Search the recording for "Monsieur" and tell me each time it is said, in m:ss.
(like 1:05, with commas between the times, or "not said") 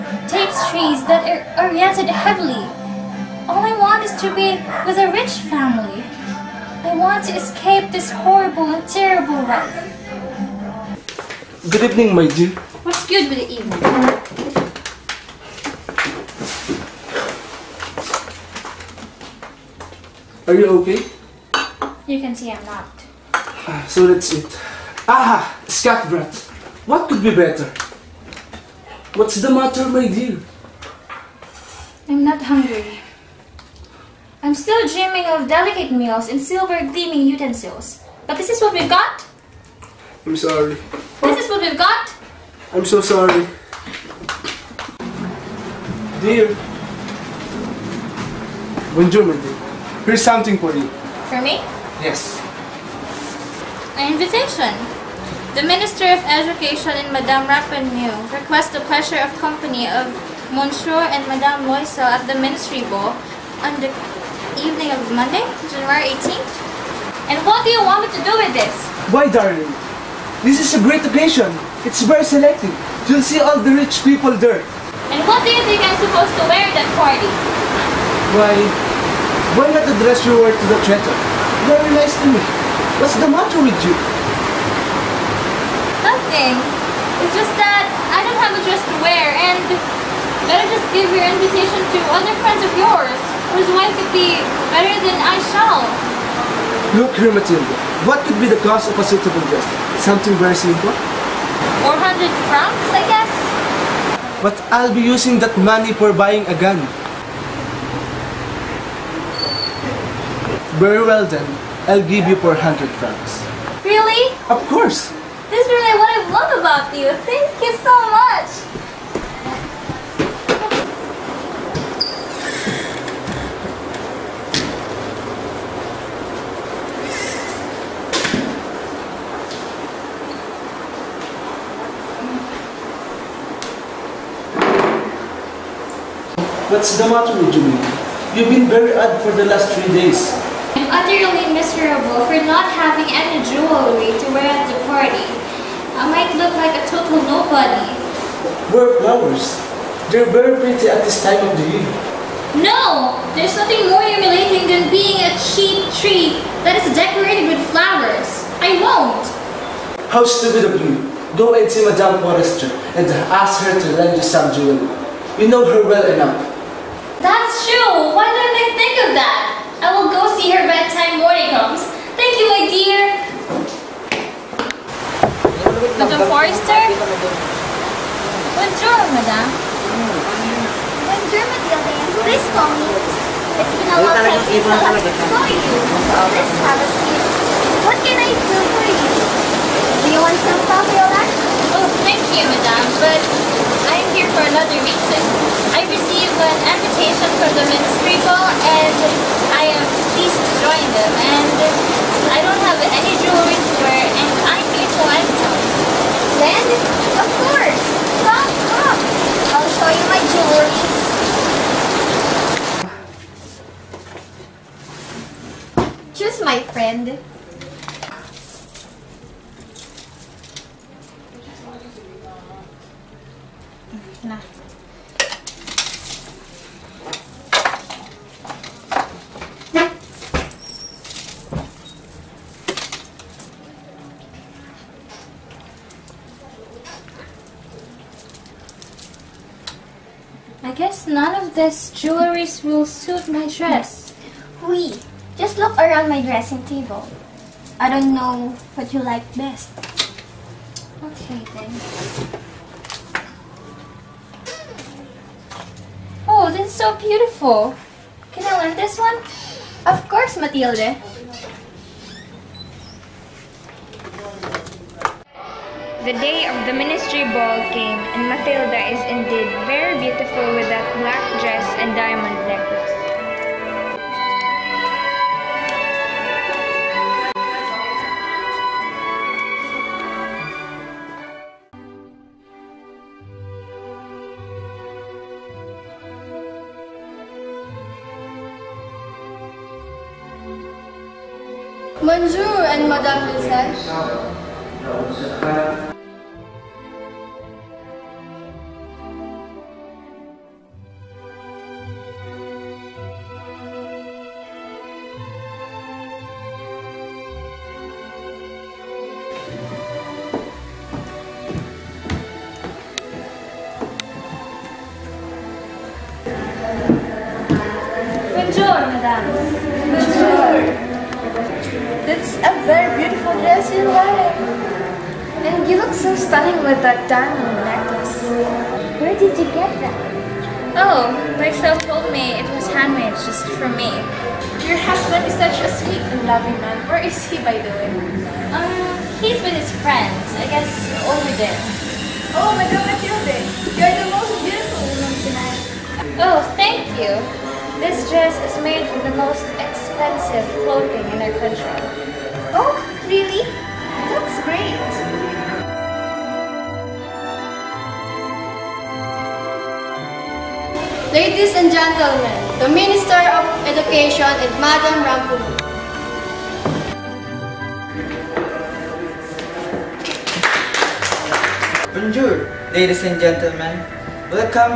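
1:00, 4:52.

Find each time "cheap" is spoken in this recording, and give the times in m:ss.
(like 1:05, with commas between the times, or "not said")
2:35.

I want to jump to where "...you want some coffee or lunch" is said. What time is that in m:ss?
3:10.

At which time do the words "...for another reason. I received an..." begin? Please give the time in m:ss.
3:14.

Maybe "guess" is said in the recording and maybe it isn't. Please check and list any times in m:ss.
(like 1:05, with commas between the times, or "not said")
1:43, 4:00, 5:40.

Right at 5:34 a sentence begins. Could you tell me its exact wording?
Your husband is such a sweet and loving man.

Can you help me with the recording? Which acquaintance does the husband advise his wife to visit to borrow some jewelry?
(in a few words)
Madame Forrester.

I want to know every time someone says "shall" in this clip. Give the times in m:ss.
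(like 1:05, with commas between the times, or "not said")
1:35.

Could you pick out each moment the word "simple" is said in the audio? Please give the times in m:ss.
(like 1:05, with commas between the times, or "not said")
1:40.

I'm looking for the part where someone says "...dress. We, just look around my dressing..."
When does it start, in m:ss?
4:03.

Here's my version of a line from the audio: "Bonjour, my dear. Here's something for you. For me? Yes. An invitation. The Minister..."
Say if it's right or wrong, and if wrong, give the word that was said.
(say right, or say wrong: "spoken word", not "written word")
right.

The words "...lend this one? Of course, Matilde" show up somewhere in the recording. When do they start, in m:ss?
4:18.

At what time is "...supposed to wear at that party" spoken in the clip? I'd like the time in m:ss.
1:15.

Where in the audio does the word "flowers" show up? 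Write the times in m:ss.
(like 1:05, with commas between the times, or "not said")
2:29, 2:37.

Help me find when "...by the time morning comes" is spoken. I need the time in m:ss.
2:50.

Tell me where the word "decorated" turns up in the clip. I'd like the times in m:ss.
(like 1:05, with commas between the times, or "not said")
2:36.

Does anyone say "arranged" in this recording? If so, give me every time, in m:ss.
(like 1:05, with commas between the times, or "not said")
not said.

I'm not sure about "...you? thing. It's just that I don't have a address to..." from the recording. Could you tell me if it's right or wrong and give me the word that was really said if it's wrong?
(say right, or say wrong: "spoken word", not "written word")
wrong: "dress", not "address".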